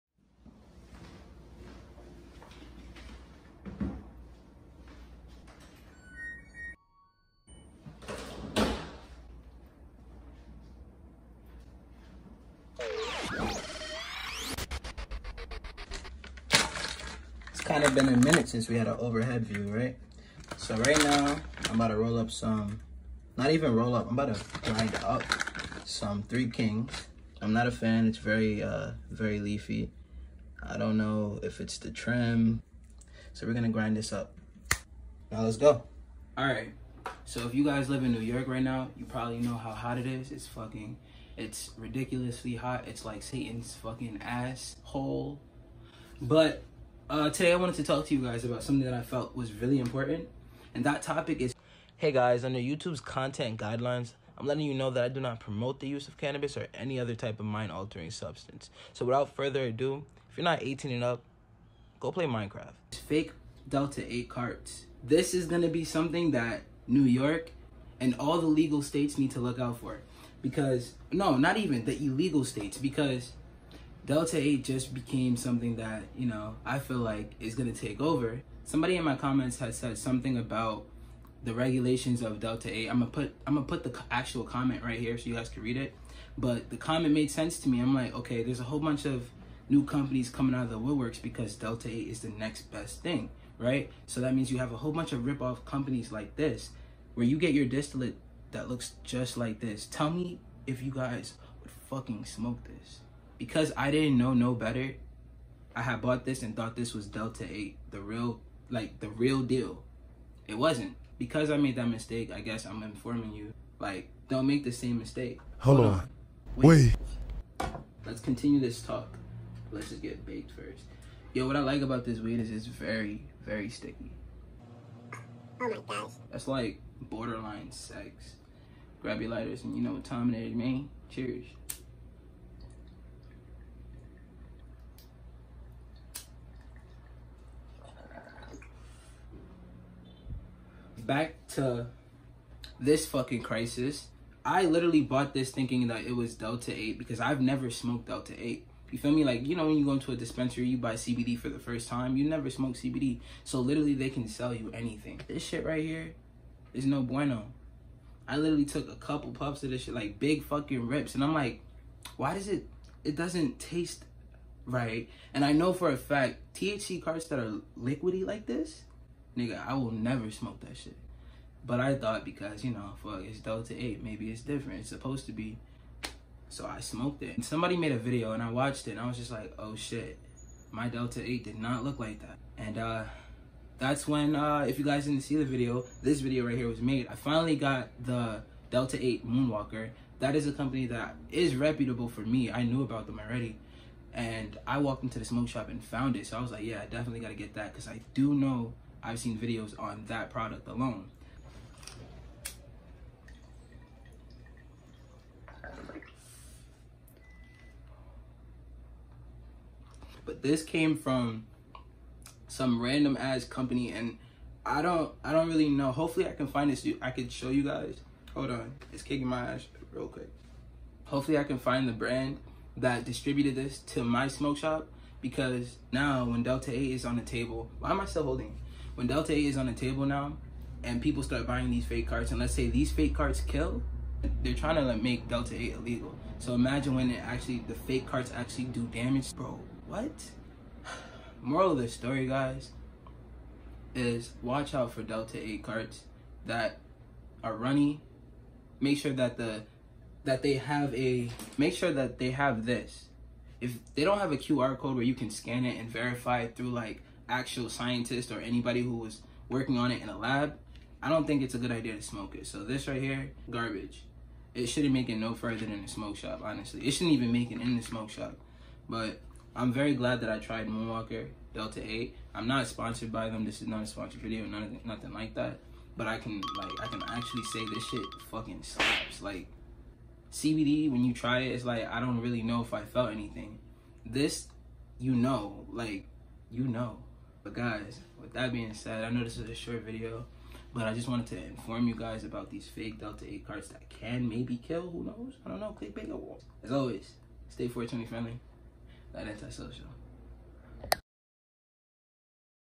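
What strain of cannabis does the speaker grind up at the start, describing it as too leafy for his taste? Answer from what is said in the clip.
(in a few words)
Three Kings.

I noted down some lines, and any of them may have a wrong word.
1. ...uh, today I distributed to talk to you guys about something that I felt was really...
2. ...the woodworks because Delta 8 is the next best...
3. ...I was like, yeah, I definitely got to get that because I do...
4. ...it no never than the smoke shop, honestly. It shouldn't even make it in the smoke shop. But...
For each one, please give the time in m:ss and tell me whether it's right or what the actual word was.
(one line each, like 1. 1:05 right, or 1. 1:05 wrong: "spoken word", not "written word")
1. 0:47 wrong: "wanted", not "distributed"
2. 1:30 right
3. 3:16 right
4. 4:25 wrong: "further", not "never".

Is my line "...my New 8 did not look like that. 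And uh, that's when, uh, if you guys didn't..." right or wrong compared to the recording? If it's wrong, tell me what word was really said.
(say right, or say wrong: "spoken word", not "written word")
wrong: "Delta", not "New".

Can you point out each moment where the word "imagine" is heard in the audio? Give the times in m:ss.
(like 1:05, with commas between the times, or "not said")
3:56.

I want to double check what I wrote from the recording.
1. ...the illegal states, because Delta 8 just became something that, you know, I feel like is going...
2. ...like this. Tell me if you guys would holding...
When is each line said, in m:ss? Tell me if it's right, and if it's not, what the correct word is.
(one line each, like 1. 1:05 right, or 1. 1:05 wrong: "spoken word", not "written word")
1. 1:11 right
2. 1:39 wrong: "fucking", not "holding".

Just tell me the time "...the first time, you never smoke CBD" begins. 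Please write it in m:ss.
2:31.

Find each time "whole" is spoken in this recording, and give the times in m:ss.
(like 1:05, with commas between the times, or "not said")
1:28, 1:34.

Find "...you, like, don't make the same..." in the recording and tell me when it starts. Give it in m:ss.
1:53.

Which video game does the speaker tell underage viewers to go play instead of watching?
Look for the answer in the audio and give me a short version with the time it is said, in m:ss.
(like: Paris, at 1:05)
Minecraft, at 1:02.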